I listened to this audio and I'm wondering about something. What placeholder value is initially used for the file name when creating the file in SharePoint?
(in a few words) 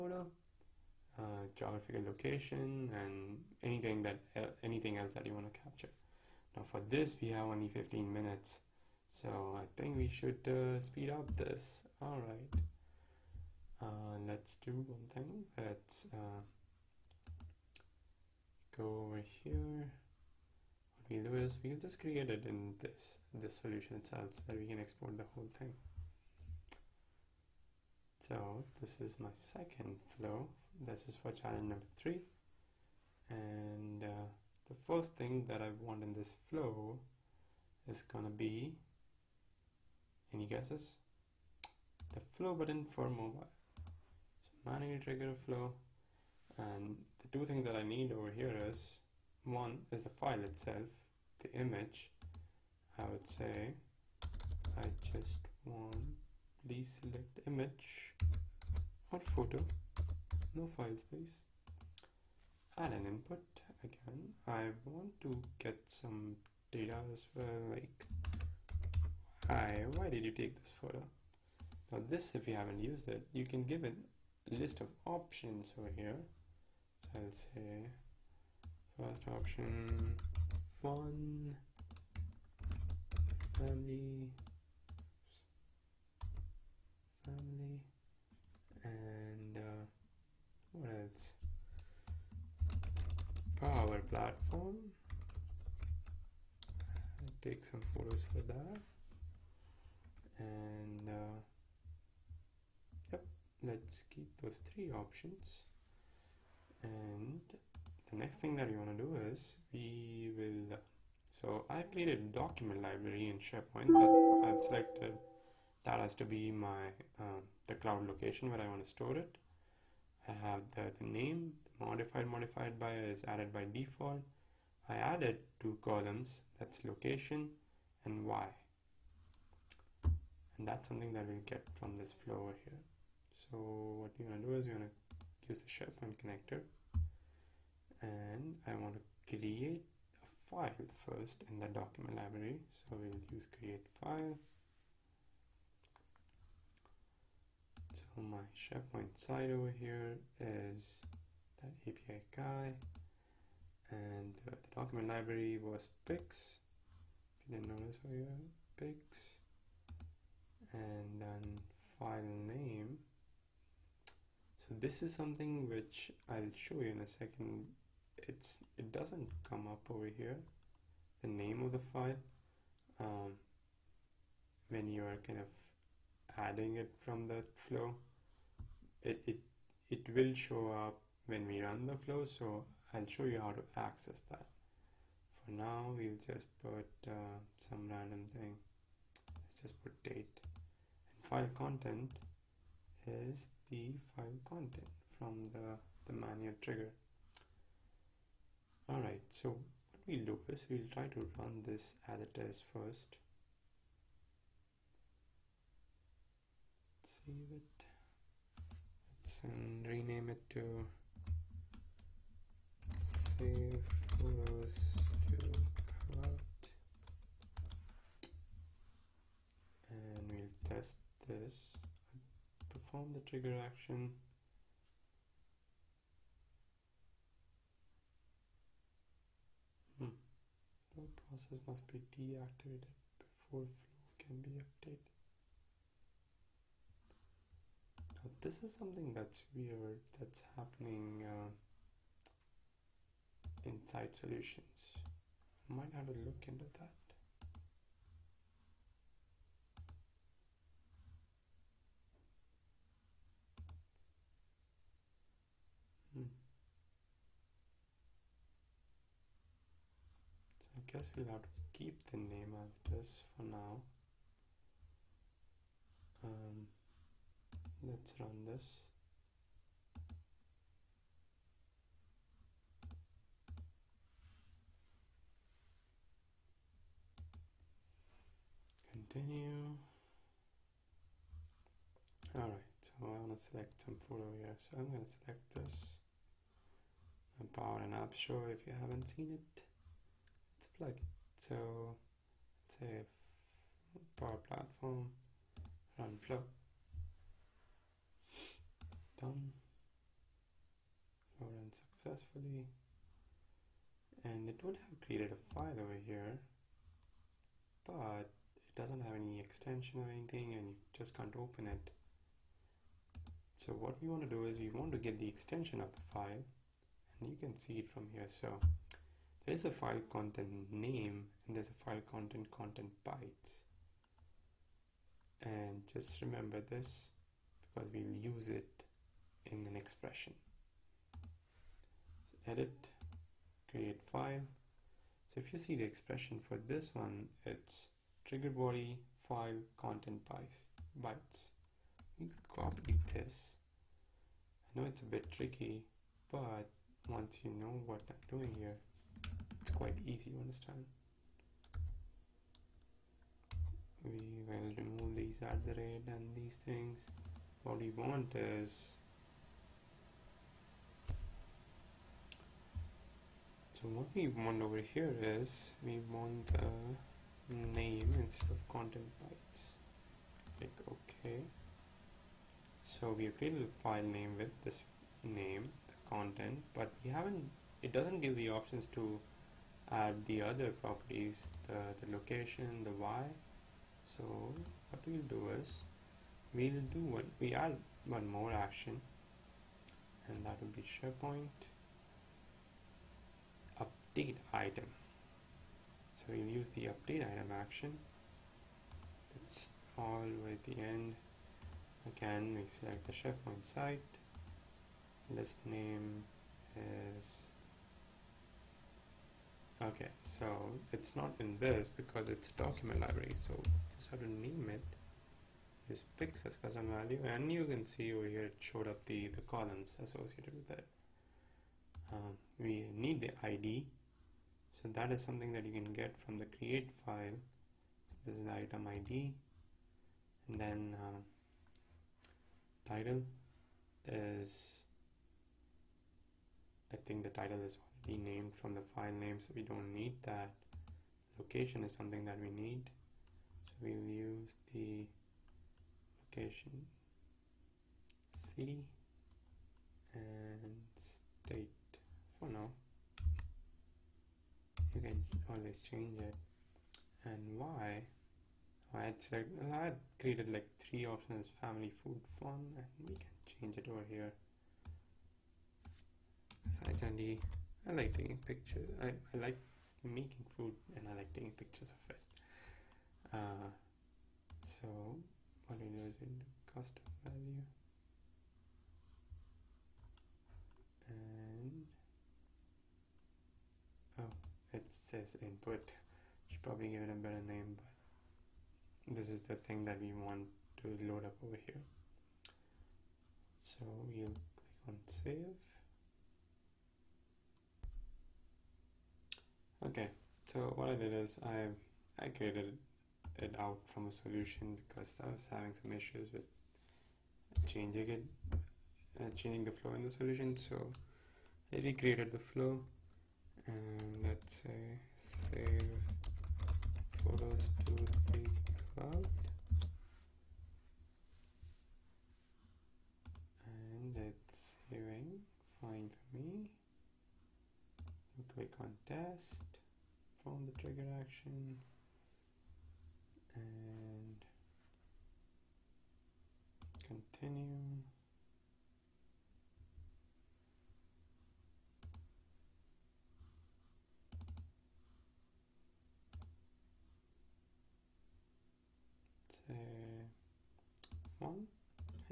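date.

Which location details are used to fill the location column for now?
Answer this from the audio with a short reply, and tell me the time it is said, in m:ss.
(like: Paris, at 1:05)
city and state, at 7:28.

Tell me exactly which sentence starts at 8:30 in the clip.
So I recreated the flow and let's say save photos to the cloud.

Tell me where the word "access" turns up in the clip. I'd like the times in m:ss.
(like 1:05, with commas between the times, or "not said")
3:03.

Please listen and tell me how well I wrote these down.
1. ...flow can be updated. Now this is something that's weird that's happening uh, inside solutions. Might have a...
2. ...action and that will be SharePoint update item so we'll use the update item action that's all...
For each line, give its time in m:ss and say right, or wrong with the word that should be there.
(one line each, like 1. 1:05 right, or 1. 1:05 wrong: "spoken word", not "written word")
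1. 3:53 right
2. 6:28 right.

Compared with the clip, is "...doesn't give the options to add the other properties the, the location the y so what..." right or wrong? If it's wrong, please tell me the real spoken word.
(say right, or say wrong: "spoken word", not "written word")
right.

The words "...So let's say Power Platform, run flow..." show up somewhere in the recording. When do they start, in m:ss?
4:51.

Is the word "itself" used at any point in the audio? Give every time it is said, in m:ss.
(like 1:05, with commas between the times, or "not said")
0:23, 0:50.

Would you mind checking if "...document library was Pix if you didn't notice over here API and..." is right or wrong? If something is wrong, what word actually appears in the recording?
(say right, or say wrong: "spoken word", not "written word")
wrong: "Pix", not "API".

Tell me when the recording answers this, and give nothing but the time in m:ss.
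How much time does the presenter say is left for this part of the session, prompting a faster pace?
0:07.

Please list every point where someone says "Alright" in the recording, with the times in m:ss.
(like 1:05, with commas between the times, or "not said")
3:18, 4:42.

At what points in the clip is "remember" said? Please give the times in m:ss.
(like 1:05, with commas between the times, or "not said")
5:26.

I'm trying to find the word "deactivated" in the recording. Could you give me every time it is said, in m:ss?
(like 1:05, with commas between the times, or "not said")
3:52.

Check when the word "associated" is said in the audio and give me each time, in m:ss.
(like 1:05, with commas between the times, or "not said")
7:00.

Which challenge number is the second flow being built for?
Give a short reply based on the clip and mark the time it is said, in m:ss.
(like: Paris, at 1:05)
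3, at 0:31.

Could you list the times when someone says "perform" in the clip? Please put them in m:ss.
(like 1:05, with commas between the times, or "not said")
3:42, 8:50.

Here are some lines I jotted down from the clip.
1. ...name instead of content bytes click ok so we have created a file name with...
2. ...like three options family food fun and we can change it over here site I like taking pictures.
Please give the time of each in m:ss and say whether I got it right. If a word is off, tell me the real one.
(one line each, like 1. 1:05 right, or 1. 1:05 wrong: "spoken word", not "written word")
1. 6:07 right
2. 7:40 right.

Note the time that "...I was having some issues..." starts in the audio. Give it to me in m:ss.
8:25.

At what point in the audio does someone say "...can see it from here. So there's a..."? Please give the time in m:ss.
5:17.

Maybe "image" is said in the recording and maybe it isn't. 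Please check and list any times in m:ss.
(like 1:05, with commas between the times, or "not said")
0:51, 0:57.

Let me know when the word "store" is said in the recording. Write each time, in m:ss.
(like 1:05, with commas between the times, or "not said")
1:58.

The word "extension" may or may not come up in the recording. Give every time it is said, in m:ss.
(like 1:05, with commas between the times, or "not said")
5:09, 5:15.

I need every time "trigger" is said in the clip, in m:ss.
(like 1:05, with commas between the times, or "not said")
0:44, 3:16, 3:43, 5:38, 8:50.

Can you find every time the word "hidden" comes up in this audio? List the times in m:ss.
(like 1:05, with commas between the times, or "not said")
not said.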